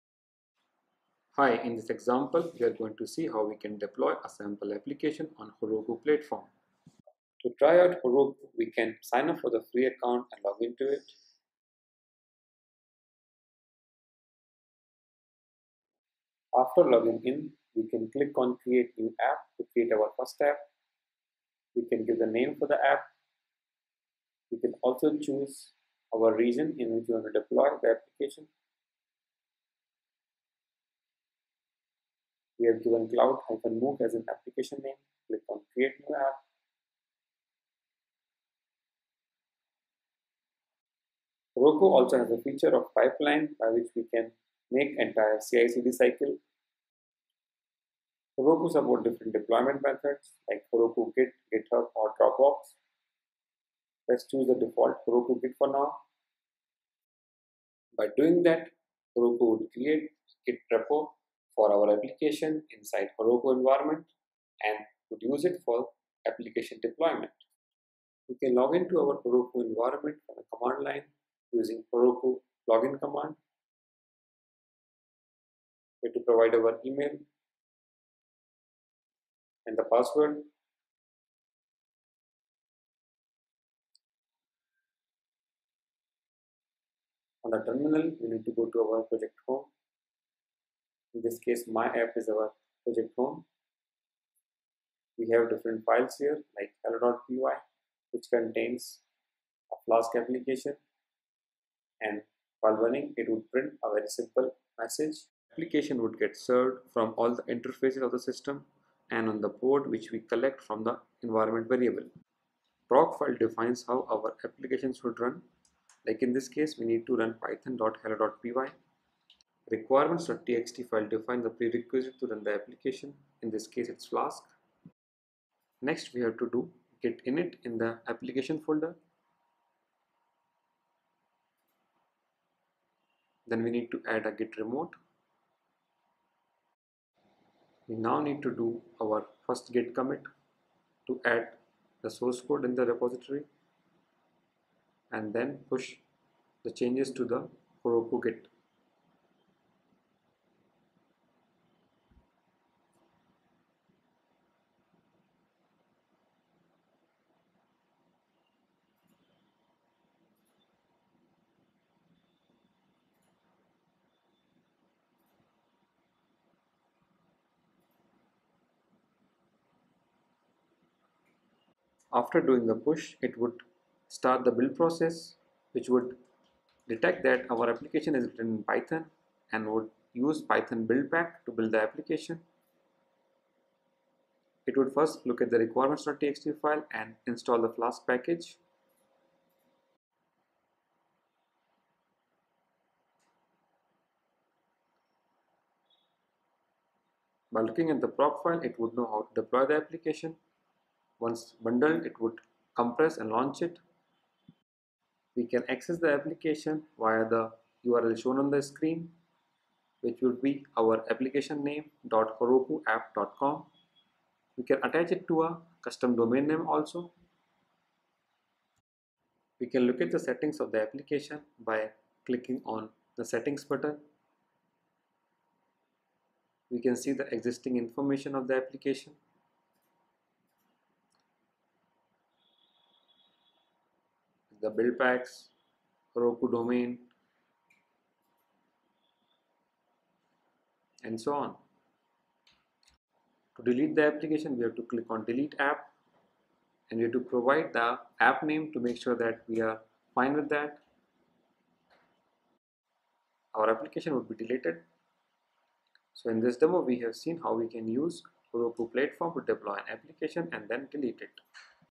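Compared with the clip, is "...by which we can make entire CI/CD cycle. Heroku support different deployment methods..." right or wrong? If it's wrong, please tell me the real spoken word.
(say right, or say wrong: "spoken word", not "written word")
right.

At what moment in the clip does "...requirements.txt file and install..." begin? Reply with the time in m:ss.
3:05.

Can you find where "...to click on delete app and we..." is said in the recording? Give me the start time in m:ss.
4:04.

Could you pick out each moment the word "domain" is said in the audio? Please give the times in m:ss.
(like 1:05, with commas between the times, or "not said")
3:36, 3:56.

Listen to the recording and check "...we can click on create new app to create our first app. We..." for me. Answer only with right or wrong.
right.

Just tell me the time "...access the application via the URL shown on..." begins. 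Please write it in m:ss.
3:25.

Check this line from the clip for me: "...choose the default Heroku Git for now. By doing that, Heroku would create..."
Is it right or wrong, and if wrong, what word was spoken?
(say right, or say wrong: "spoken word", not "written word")
right.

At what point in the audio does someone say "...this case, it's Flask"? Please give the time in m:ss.
2:03.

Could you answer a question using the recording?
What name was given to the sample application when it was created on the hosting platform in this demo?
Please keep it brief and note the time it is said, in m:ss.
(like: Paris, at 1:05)
cloud MOOC, at 0:33.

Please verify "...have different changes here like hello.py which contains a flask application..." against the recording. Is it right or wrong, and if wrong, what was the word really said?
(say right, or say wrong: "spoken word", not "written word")
wrong: "files", not "changes".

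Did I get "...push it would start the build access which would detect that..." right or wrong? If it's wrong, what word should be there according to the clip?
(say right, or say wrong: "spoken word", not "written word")
wrong: "process", not "access".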